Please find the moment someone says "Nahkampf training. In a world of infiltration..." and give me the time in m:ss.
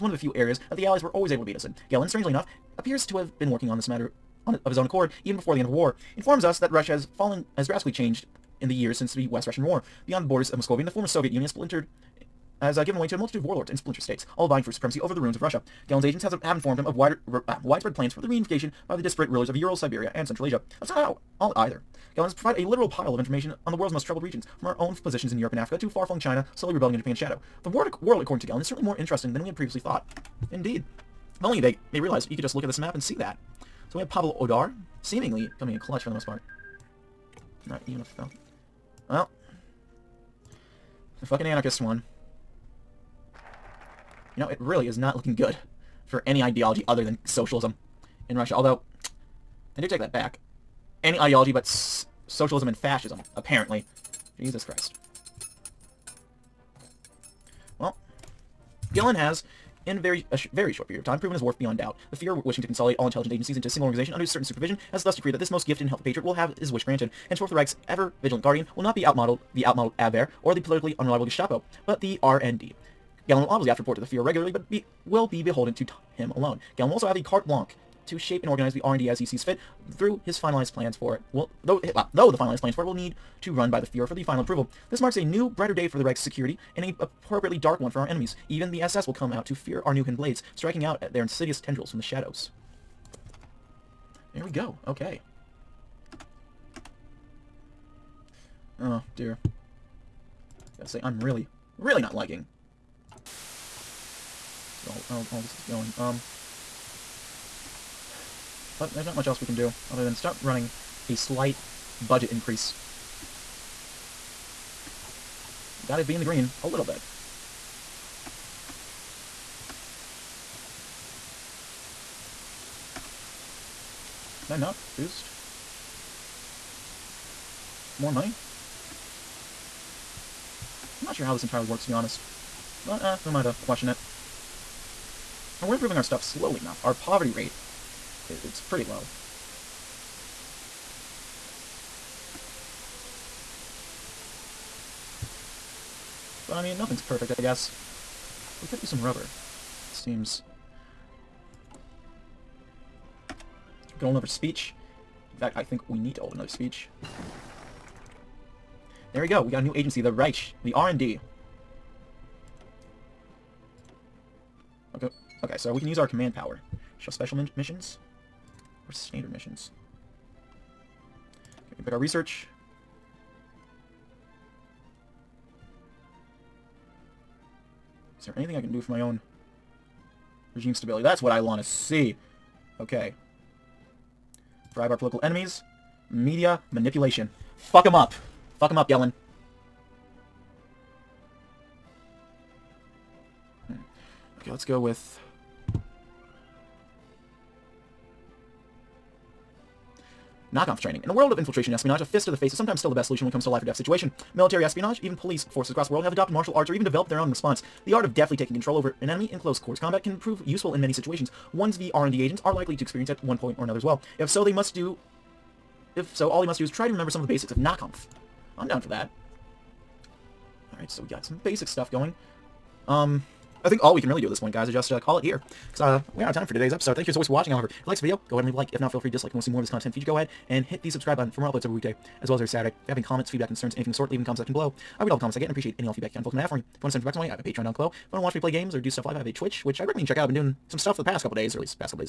3:20.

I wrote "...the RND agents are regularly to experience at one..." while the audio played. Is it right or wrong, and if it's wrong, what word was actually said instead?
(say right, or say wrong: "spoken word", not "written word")
wrong: "likely", not "regularly".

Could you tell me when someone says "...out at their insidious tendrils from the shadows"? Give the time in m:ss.
1:30.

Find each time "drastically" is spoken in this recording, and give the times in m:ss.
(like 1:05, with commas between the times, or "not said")
0:07.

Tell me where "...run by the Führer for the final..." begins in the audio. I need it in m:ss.
1:23.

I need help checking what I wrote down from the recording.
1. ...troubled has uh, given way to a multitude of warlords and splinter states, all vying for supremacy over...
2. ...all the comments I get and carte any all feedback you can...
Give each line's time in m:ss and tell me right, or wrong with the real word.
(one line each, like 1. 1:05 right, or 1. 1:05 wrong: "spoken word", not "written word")
1. 0:11 wrong: "splintered", not "troubled"
2. 3:55 wrong: "appreciate", not "carte".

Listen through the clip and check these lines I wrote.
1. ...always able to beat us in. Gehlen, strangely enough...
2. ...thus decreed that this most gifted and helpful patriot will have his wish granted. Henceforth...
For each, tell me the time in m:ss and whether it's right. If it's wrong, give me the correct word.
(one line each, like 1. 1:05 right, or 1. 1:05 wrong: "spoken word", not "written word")
1. 0:01 right
2. 1:05 right.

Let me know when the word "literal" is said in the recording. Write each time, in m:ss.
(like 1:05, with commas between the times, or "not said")
0:22.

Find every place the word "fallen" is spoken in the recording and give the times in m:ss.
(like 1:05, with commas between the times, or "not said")
0:07.